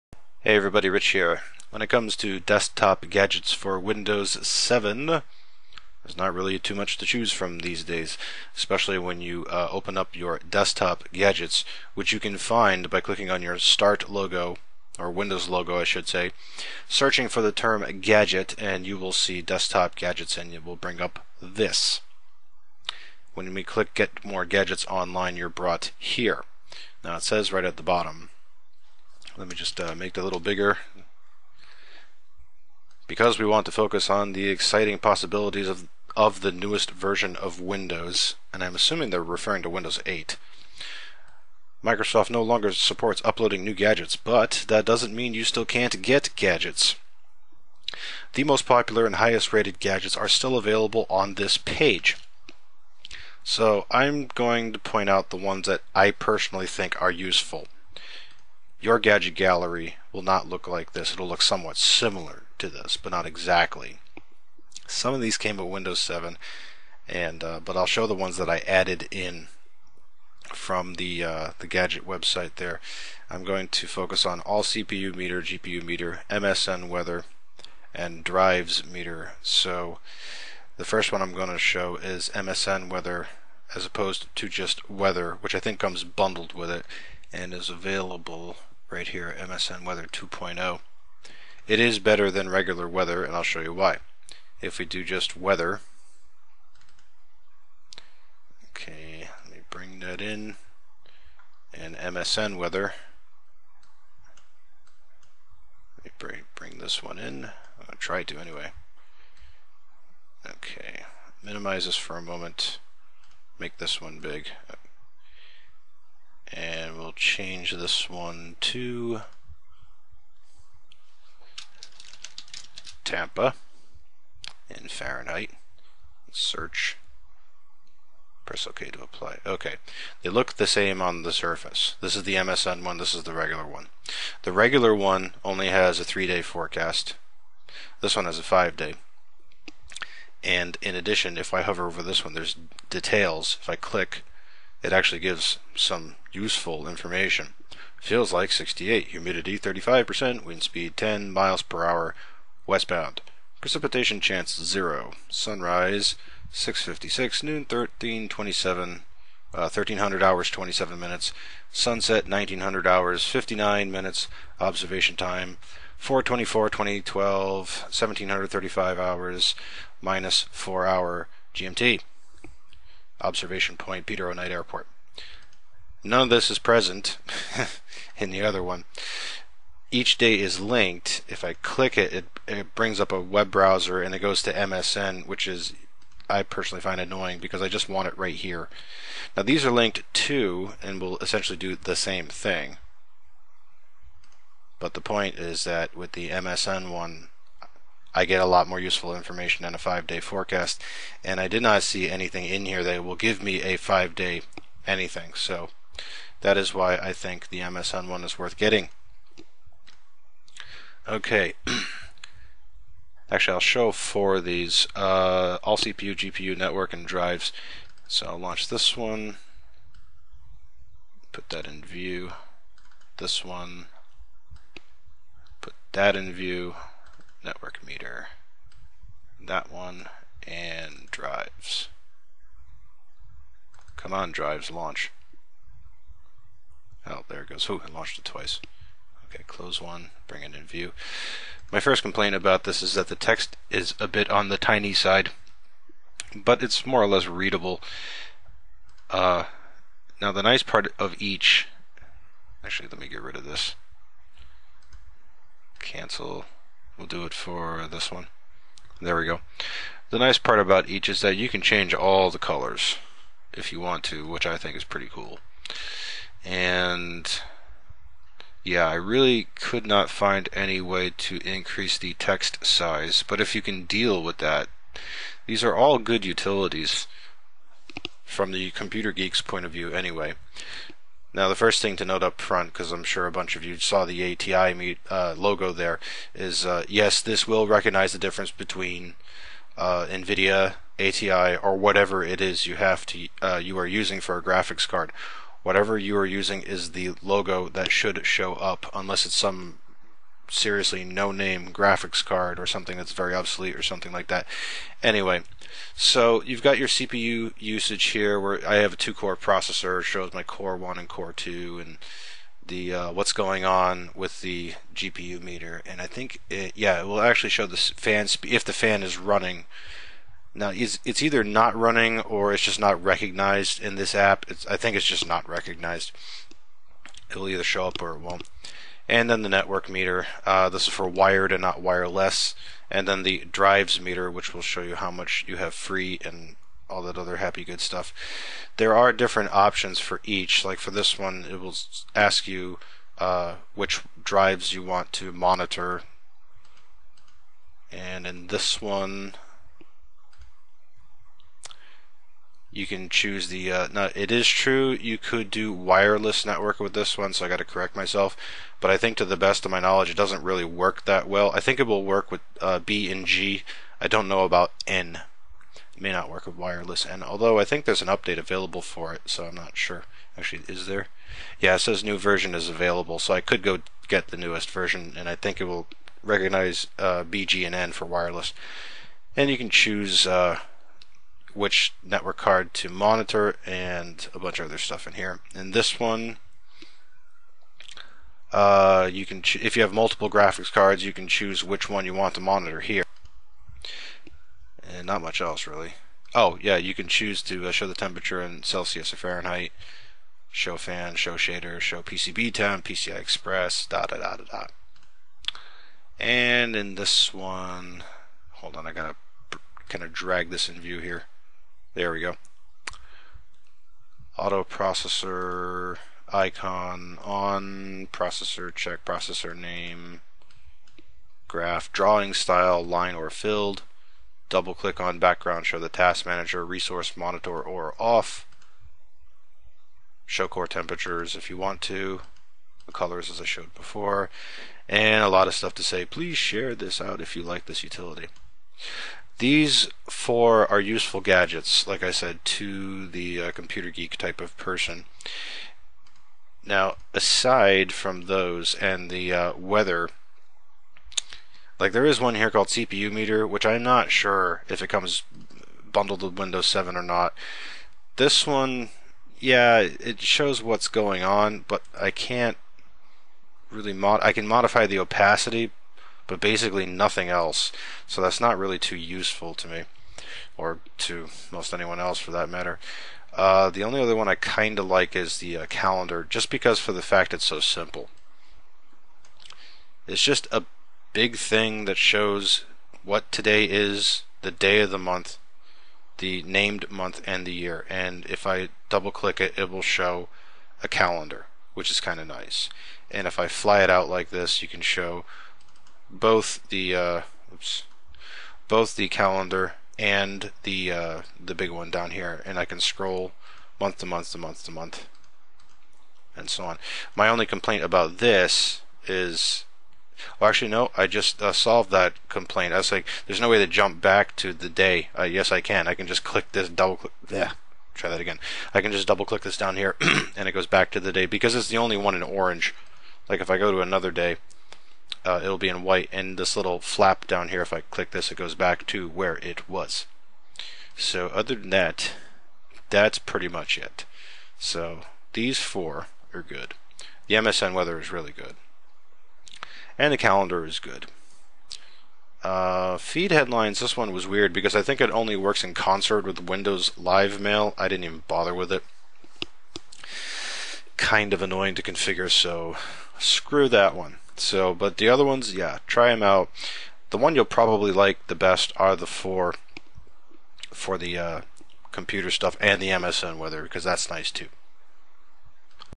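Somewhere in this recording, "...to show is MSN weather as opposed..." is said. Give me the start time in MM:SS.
01:21.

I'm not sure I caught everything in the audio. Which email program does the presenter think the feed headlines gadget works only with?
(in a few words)
Windows Live Mail.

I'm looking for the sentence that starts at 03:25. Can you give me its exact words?
So that is why I think the MSN one is worth getting.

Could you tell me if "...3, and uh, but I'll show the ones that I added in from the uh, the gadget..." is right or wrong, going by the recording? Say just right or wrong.
wrong.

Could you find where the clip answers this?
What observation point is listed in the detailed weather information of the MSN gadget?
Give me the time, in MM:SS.
02:54.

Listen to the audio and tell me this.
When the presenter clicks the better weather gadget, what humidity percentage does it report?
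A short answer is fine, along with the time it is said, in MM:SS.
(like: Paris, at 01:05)
35%, at 02:29.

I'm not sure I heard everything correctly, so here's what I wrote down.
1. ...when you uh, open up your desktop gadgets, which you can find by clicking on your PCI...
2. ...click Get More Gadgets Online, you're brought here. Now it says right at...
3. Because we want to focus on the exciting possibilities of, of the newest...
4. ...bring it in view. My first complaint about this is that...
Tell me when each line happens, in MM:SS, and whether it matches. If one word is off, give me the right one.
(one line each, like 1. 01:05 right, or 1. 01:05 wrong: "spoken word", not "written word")
1. 00:08 wrong: "Start", not "PCI"
2. 00:23 right
3. 00:33 right
4. 04:00 right.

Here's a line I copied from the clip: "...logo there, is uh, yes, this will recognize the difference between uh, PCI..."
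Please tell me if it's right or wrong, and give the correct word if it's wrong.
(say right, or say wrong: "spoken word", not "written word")
wrong: "NVIDIA", not "PCI".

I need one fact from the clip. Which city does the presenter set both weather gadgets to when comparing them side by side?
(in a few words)
Tampa.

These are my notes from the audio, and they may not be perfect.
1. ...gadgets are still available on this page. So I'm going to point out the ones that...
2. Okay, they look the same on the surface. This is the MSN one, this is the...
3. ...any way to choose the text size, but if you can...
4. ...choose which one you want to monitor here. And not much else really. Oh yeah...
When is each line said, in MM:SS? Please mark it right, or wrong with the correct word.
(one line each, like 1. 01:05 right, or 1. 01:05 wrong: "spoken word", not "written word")
1. 00:49 right
2. 02:09 right
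3. 04:30 wrong: "increase", not "choose"
4. 06:31 right.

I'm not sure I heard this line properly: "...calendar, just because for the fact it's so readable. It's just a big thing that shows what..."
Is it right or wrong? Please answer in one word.
wrong.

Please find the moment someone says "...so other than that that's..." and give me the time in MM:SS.
08:50.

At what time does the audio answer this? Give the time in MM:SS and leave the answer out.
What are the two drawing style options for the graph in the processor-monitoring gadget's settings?
07:02.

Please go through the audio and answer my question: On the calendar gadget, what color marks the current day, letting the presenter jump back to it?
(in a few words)
orange.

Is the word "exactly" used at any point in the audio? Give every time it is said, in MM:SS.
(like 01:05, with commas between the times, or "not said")
01:03.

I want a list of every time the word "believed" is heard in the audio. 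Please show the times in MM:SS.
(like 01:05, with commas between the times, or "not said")
not said.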